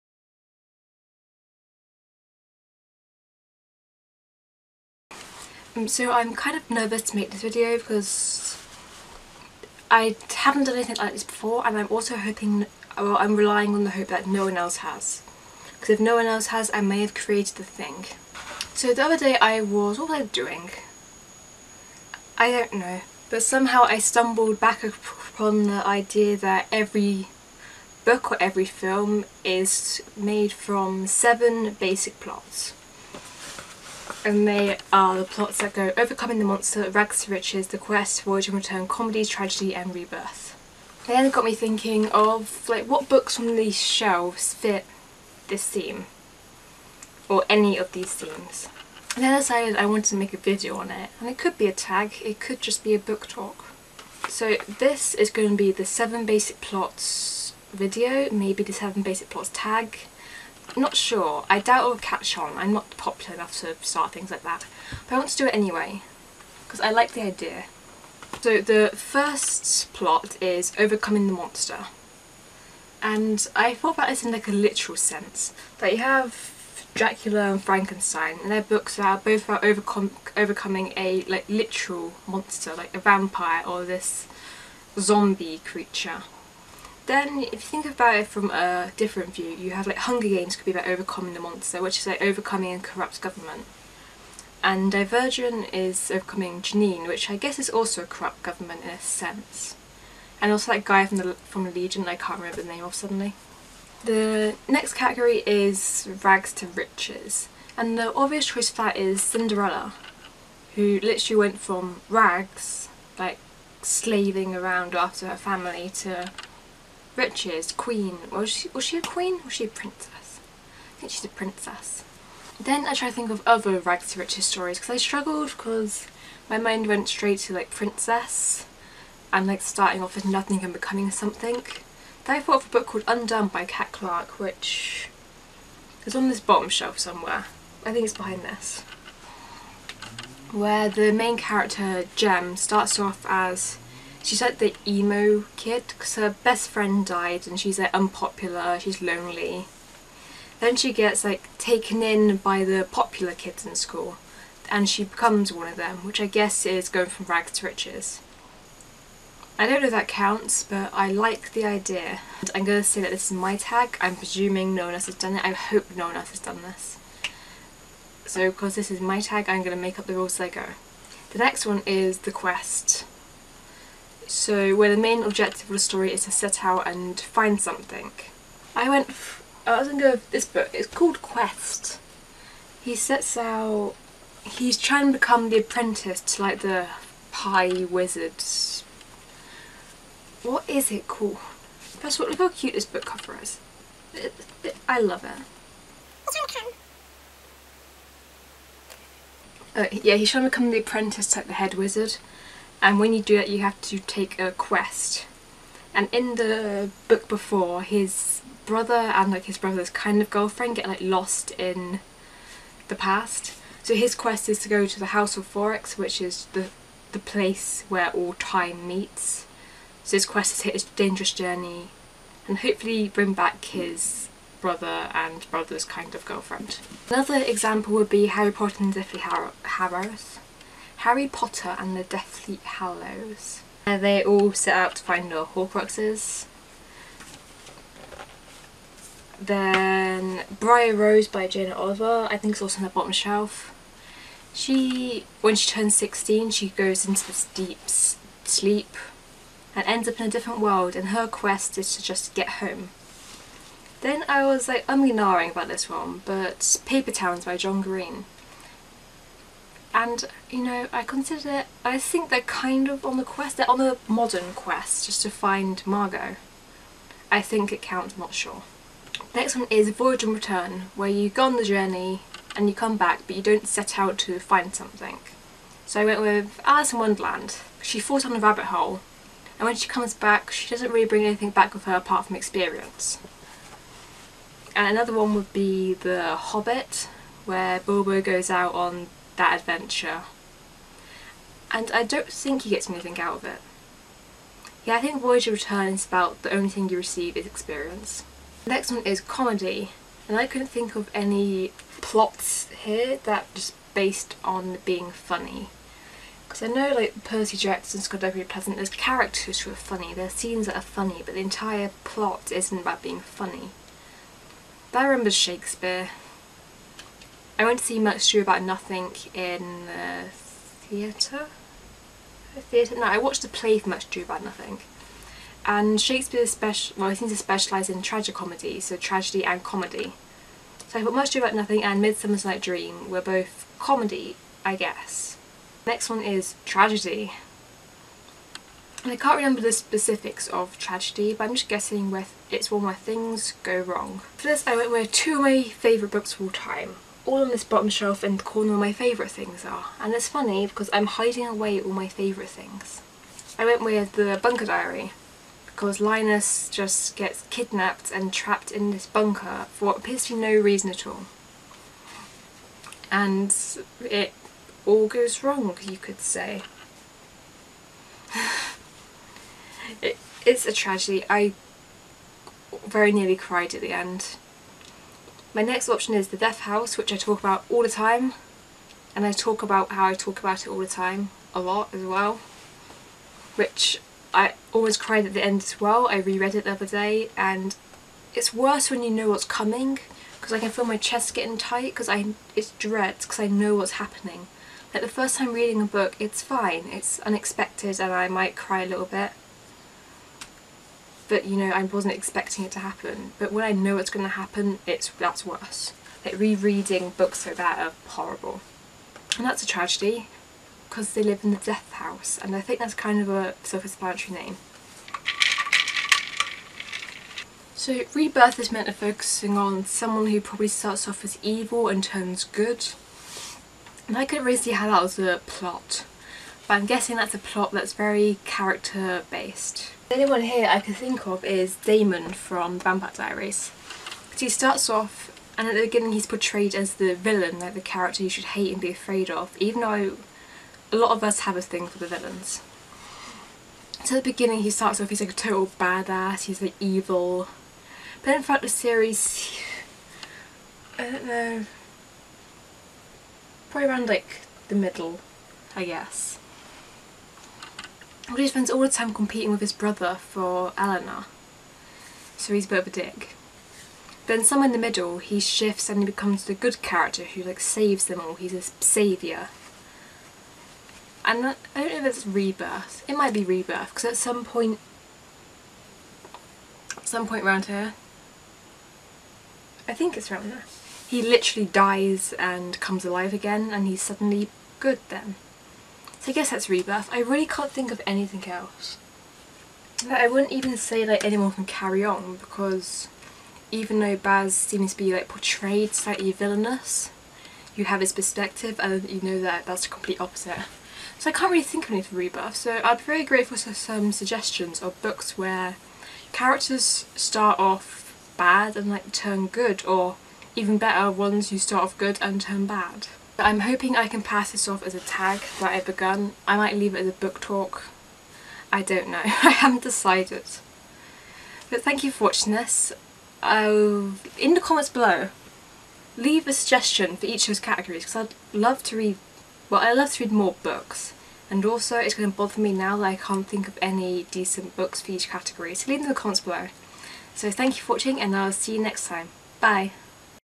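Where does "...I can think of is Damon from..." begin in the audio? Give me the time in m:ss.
7:10.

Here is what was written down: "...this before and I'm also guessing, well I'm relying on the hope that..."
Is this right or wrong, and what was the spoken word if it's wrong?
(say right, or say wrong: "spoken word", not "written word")
wrong: "hoping", not "guessing".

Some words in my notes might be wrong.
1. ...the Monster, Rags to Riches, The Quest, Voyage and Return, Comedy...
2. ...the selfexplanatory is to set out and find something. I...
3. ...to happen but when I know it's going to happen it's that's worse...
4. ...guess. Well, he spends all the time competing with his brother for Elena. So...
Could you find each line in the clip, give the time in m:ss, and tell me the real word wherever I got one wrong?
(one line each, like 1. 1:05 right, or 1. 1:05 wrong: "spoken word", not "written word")
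1. 0:36 right
2. 2:55 wrong: "story", not "selfexplanatory"
3. 6:42 right
4. 7:35 right.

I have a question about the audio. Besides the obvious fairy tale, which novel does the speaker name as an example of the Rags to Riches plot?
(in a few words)
Undone.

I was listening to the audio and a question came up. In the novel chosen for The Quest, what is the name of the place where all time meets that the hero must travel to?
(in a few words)
House of Foryx.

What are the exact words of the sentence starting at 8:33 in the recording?
I'm hoping I can pass this off as a tag that I've begun.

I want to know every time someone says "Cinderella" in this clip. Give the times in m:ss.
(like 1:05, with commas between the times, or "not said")
1:49.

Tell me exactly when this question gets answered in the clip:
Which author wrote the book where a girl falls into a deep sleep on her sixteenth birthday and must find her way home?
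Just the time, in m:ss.
4:01.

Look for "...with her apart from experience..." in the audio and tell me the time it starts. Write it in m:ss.
4:41.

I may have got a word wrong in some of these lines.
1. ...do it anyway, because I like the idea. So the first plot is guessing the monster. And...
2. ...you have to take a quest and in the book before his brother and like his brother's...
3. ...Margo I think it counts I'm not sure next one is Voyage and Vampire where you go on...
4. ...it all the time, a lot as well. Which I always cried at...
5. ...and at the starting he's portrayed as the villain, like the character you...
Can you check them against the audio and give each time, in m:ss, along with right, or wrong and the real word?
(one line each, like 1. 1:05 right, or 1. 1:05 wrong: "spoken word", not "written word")
1. 1:05 wrong: "overcoming", not "guessing"
2. 3:23 right
3. 4:25 wrong: "Return", not "Vampire"
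4. 6:20 right
5. 7:15 wrong: "beginning", not "starting".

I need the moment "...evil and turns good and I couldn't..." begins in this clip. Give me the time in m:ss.
7:01.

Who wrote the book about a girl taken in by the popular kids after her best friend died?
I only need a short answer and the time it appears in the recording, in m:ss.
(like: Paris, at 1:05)
Cat Clarke, at 2:13.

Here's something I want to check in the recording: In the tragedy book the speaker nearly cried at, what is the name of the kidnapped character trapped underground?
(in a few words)
Linus.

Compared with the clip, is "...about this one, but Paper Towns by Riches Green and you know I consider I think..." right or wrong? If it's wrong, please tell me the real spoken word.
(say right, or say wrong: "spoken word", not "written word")
wrong: "John", not "Riches".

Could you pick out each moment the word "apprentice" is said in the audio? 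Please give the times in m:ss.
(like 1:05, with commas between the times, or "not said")
3:05, 3:20.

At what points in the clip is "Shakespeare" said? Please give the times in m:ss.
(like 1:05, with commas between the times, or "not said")
5:15, 5:26.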